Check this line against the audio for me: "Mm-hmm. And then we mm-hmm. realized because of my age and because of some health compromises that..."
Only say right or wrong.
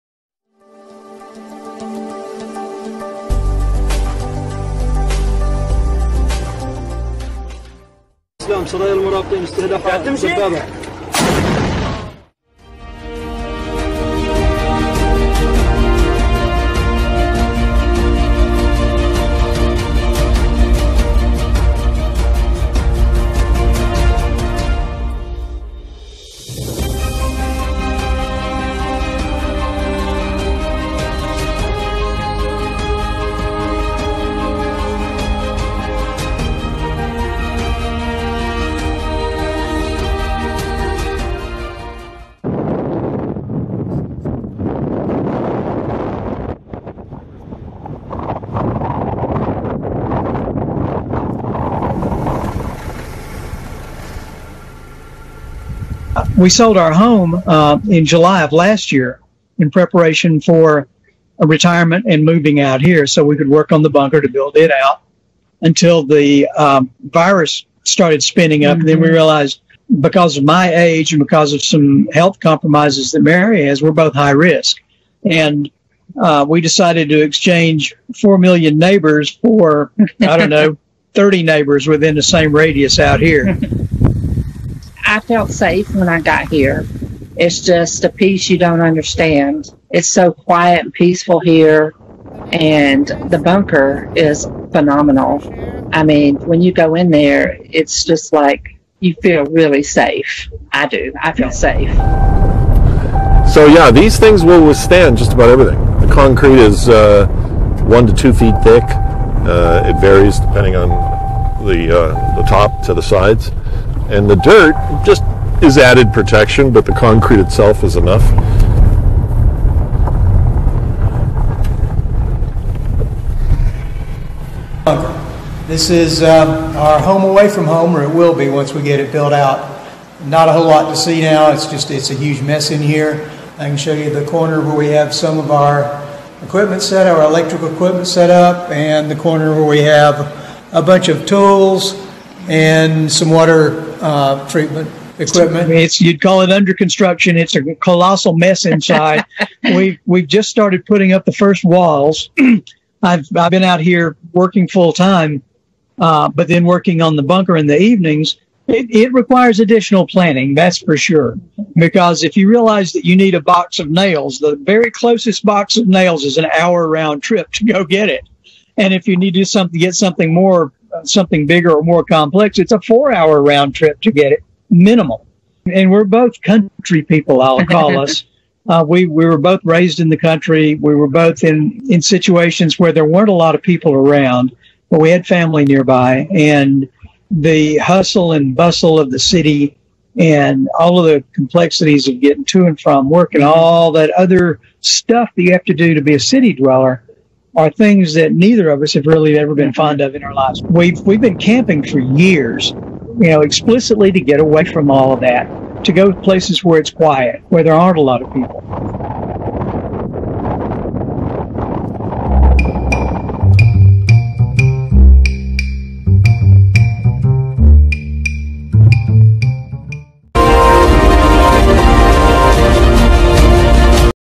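right.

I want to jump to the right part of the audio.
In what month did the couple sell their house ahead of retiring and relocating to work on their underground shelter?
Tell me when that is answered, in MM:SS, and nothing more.
00:58.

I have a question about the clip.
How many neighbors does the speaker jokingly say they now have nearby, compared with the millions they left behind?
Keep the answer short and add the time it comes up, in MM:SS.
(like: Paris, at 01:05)
30, at 01:21.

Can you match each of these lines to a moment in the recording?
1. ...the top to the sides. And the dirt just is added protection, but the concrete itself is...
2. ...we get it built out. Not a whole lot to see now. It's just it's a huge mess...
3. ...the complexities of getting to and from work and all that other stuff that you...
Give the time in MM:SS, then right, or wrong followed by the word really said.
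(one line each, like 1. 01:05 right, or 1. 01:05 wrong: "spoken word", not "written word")
1. 01:52 right
2. 02:08 right
3. 03:11 right.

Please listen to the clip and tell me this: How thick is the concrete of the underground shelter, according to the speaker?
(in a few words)
1 to 2 feet.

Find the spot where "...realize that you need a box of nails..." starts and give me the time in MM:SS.
02:42.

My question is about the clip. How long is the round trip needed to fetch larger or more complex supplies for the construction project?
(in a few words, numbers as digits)
4 hours.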